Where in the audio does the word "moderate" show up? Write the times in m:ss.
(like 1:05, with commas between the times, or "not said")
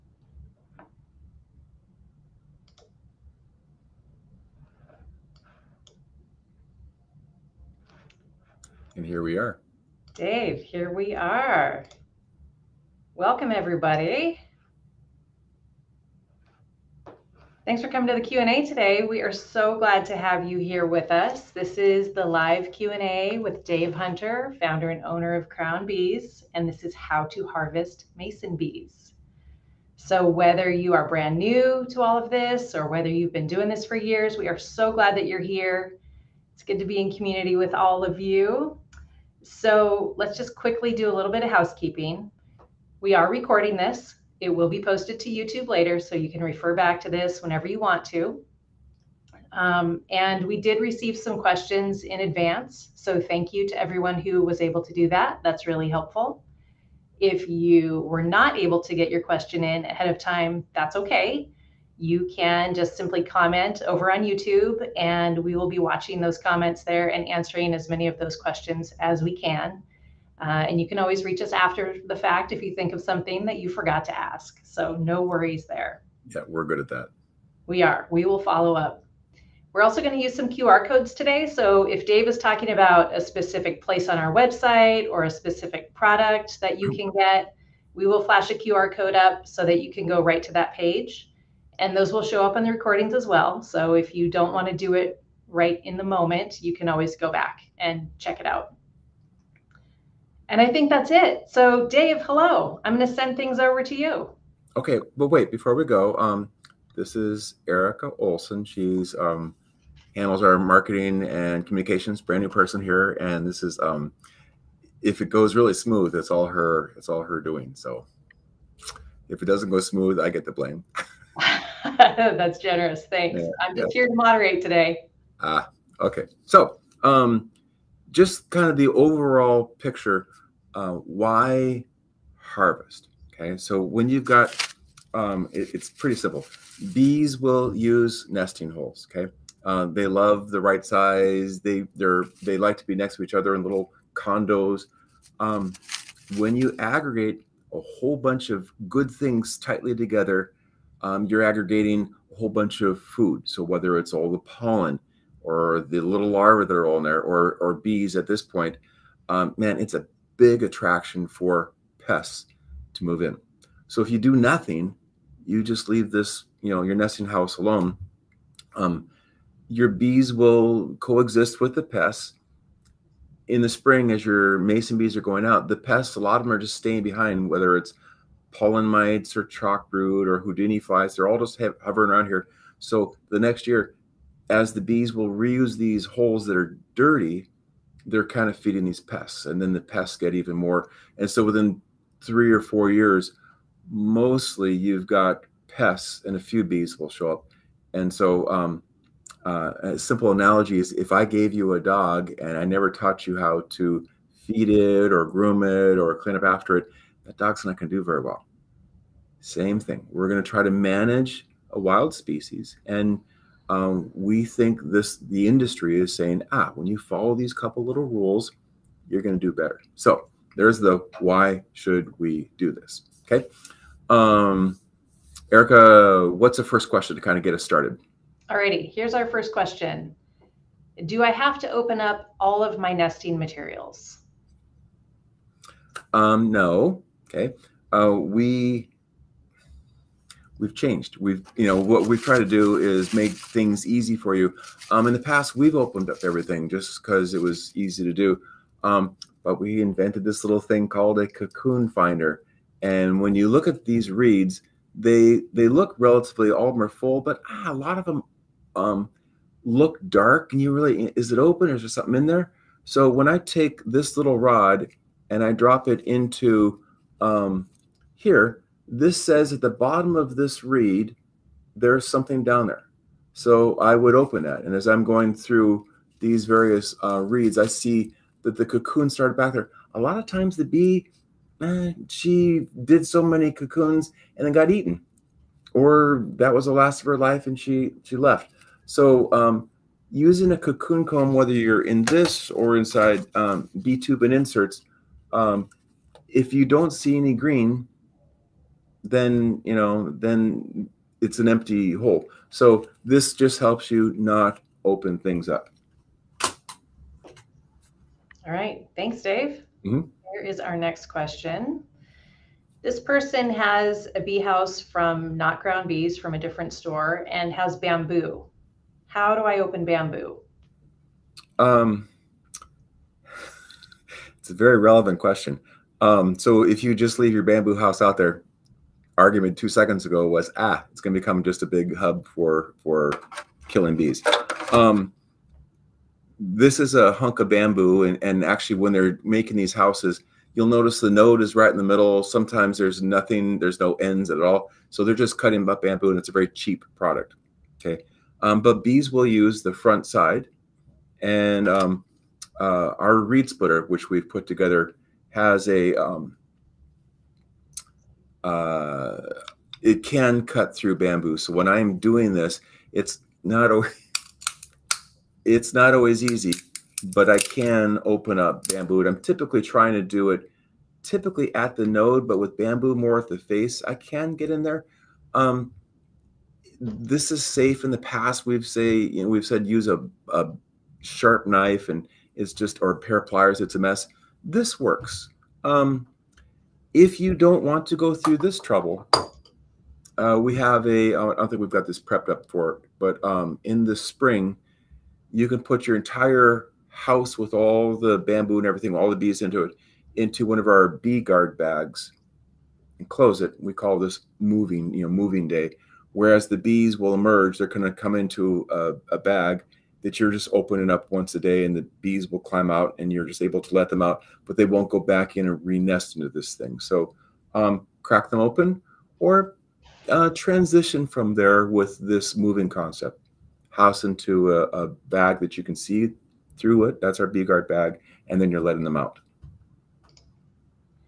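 2:04.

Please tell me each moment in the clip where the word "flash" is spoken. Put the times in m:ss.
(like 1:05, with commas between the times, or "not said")
1:28.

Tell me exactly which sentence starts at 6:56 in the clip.
So um, crack them open or uh, transition from there with this moving concept.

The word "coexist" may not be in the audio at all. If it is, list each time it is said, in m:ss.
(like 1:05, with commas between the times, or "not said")
2:50.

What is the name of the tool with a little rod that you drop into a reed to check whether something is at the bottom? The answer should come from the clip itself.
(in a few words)
cocoon finder.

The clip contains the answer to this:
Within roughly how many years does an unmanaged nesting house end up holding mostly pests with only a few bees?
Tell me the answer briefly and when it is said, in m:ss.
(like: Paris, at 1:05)
3 or 4 years, at 3:12.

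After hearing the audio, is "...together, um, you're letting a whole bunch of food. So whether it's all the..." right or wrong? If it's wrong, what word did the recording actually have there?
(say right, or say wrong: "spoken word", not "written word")
wrong: "aggregating", not "letting".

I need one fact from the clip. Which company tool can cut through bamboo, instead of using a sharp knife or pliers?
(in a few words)
reed splitter.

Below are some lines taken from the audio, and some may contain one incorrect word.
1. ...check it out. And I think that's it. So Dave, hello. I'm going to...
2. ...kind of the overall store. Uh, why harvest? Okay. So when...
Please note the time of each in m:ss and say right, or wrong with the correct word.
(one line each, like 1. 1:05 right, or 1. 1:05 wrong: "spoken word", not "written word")
1. 1:38 right
2. 2:08 wrong: "picture", not "store".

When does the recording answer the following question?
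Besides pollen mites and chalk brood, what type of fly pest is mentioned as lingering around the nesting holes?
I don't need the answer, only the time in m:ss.
3:00.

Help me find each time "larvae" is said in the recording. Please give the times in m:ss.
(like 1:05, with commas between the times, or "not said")
2:36.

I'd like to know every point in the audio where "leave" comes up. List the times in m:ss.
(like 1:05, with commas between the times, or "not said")
2:45, 5:27.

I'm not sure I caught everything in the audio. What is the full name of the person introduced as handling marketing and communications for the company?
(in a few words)
Erica Olson.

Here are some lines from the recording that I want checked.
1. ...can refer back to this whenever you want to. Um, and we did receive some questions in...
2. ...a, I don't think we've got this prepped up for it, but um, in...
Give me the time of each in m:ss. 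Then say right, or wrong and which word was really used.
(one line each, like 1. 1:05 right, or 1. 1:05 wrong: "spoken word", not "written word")
1. 0:46 right
2. 6:30 right.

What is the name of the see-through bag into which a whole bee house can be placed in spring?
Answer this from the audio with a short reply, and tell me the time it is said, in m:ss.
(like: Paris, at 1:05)
bee guard bag, at 7:07.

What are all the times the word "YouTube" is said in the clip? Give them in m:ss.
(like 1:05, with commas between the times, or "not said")
0:45, 1:04.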